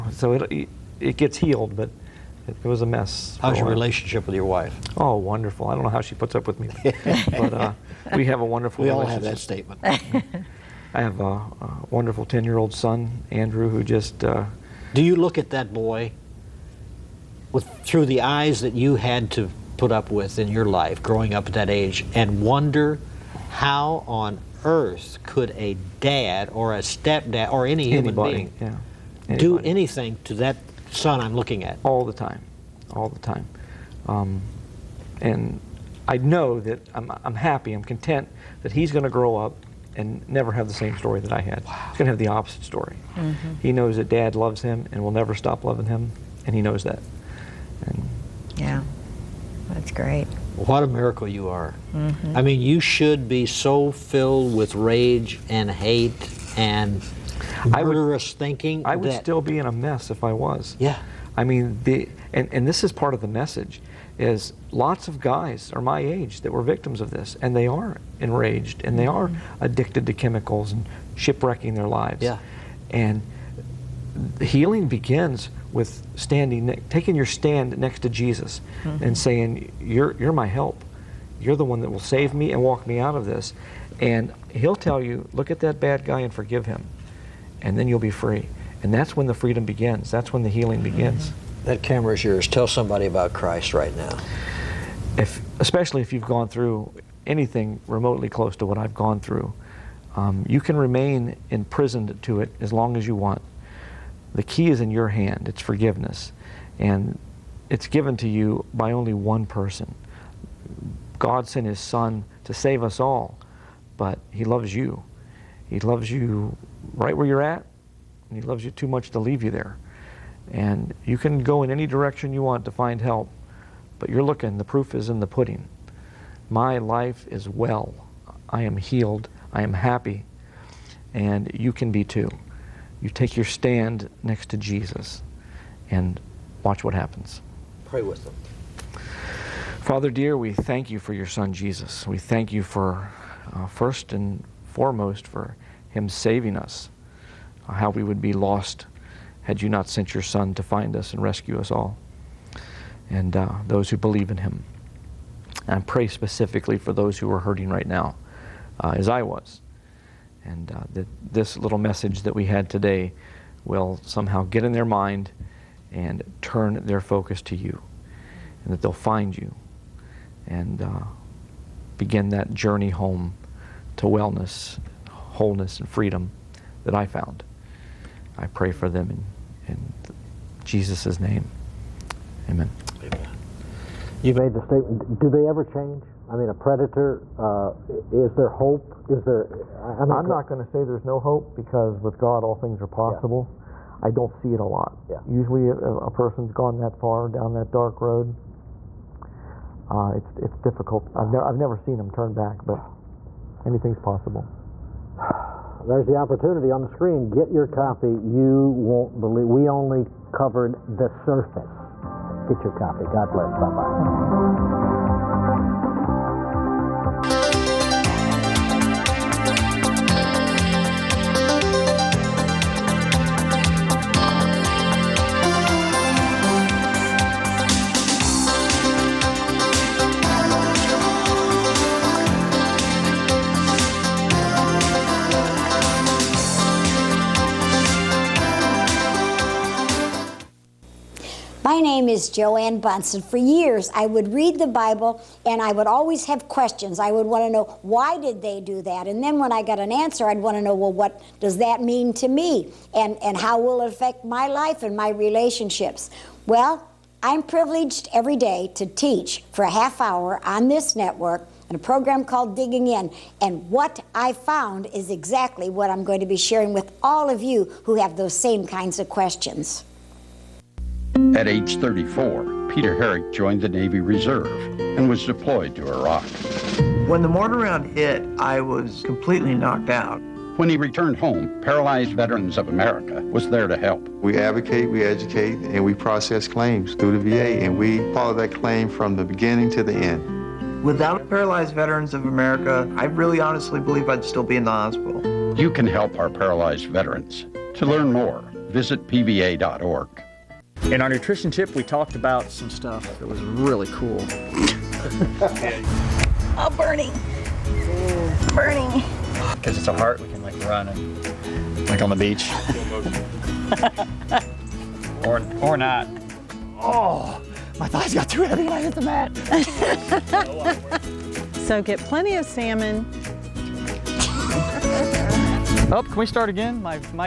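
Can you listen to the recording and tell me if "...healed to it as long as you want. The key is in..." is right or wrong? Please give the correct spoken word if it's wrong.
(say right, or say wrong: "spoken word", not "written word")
wrong: "imprisoned", not "healed".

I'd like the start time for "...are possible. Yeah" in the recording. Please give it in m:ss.
3:12.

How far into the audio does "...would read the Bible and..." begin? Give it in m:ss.
4:04.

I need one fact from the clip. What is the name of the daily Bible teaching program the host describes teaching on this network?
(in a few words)
Digging In.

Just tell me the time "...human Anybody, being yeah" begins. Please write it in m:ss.
0:27.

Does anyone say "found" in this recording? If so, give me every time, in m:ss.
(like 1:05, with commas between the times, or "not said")
2:57, 4:24.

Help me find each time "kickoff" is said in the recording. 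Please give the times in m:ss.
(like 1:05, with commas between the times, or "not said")
not said.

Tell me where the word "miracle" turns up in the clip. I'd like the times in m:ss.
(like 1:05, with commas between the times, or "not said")
0:50.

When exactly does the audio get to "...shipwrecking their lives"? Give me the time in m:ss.
1:11.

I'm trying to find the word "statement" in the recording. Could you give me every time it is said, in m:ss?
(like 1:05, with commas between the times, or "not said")
0:09, 3:04.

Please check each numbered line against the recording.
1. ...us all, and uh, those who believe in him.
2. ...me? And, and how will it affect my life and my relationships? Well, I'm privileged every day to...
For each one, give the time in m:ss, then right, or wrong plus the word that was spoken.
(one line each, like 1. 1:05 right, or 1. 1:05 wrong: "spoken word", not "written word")
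1. 2:31 right
2. 4:12 right.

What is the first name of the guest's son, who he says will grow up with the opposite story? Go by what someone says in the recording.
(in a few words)
Andrew.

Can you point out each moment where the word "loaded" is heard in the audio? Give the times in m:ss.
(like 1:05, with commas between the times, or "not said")
not said.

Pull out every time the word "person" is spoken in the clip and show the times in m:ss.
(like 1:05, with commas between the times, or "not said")
1:49, 3:16.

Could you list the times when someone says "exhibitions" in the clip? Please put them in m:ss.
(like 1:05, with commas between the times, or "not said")
not said.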